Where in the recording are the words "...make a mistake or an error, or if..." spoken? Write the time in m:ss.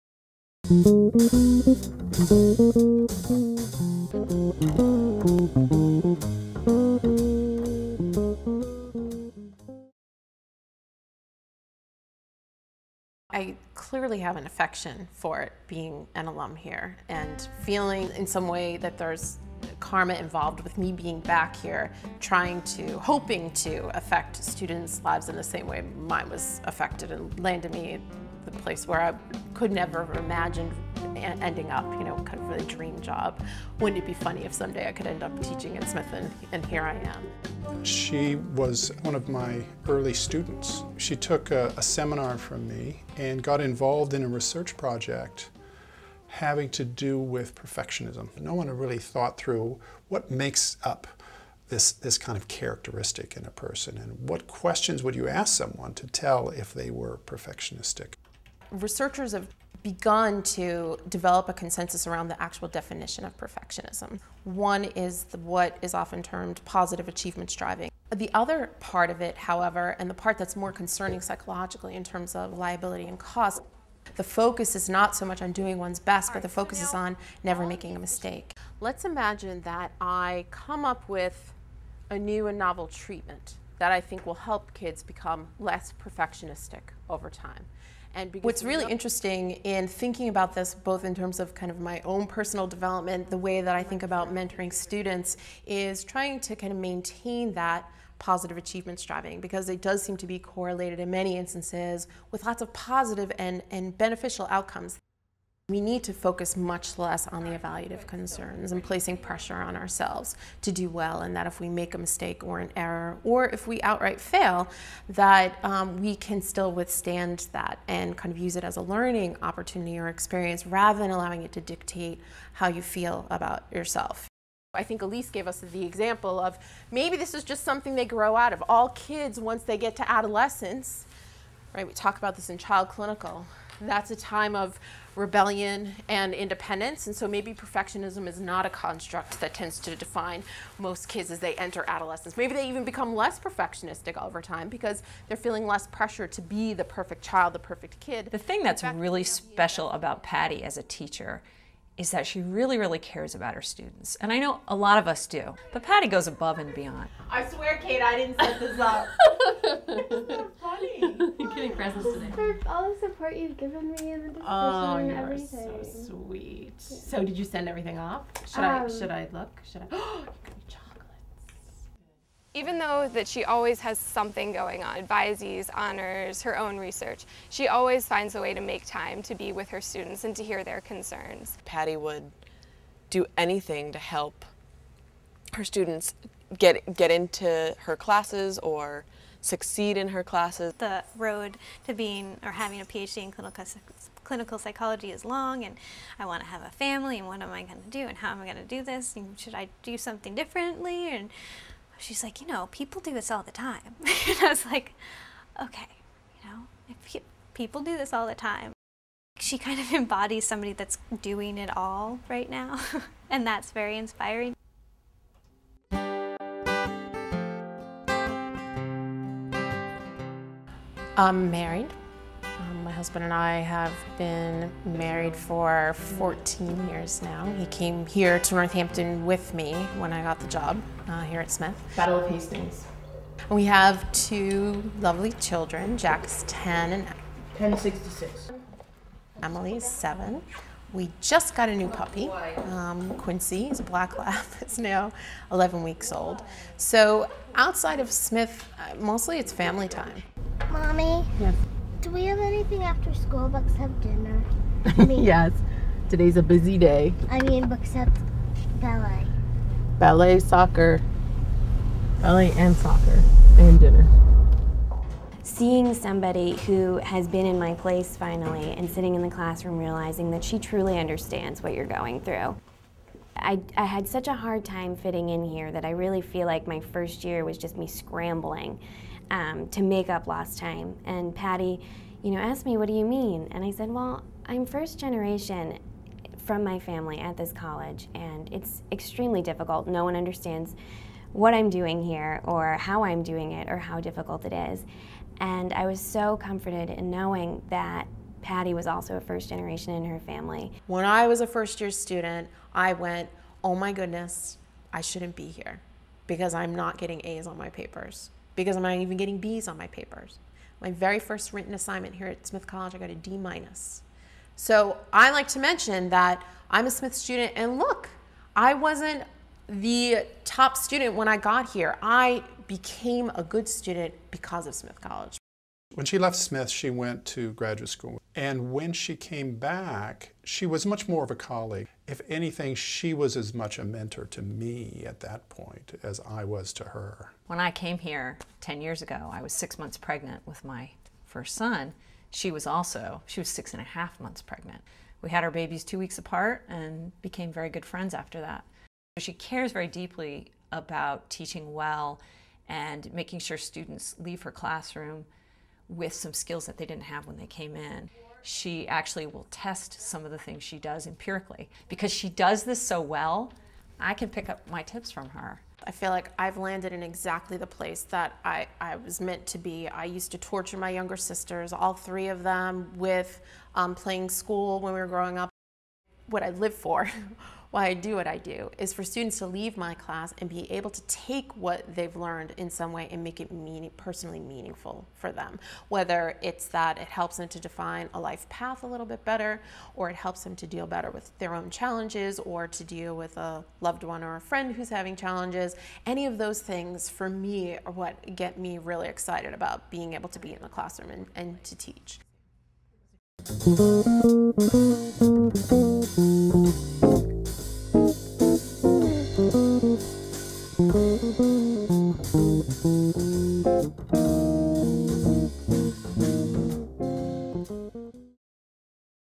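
1:51.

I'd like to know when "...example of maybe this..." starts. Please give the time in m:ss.
2:05.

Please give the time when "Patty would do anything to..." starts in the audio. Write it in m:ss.
3:01.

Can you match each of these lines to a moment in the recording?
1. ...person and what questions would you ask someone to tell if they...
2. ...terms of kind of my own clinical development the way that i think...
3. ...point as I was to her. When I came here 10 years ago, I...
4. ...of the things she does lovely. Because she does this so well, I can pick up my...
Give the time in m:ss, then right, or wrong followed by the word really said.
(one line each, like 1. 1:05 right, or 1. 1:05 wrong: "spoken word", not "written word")
1. 0:53 right
2. 1:31 wrong: "personal", not "clinical"
3. 5:35 right
4. 6:00 wrong: "empirically", not "lovely".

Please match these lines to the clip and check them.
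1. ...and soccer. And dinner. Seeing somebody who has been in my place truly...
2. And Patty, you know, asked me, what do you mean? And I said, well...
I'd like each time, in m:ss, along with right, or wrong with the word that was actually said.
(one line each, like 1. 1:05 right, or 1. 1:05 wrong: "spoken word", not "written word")
1. 4:22 wrong: "finally", not "truly"
2. 4:41 right.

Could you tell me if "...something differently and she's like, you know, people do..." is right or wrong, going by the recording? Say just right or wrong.
right.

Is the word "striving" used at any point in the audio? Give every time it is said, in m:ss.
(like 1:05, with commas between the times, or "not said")
1:07, 1:38.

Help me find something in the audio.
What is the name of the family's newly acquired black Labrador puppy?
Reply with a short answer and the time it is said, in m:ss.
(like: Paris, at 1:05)
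Quincy, at 4:03.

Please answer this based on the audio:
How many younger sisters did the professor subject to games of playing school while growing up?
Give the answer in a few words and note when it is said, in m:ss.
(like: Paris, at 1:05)
3, at 6:11.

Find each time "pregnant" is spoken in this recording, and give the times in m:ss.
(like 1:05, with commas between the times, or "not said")
5:39, 5:44.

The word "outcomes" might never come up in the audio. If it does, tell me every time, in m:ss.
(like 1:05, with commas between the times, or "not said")
1:44.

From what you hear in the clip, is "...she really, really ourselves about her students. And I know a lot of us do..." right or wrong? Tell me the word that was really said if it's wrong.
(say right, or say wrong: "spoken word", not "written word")
wrong: "cares", not "ourselves".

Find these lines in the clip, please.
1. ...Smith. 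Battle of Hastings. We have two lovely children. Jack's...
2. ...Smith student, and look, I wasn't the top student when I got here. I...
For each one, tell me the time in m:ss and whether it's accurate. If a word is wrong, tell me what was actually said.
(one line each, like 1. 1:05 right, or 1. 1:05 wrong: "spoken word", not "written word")
1. 3:51 right
2. 5:16 right.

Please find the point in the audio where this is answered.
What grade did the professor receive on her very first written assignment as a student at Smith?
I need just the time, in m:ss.
5:13.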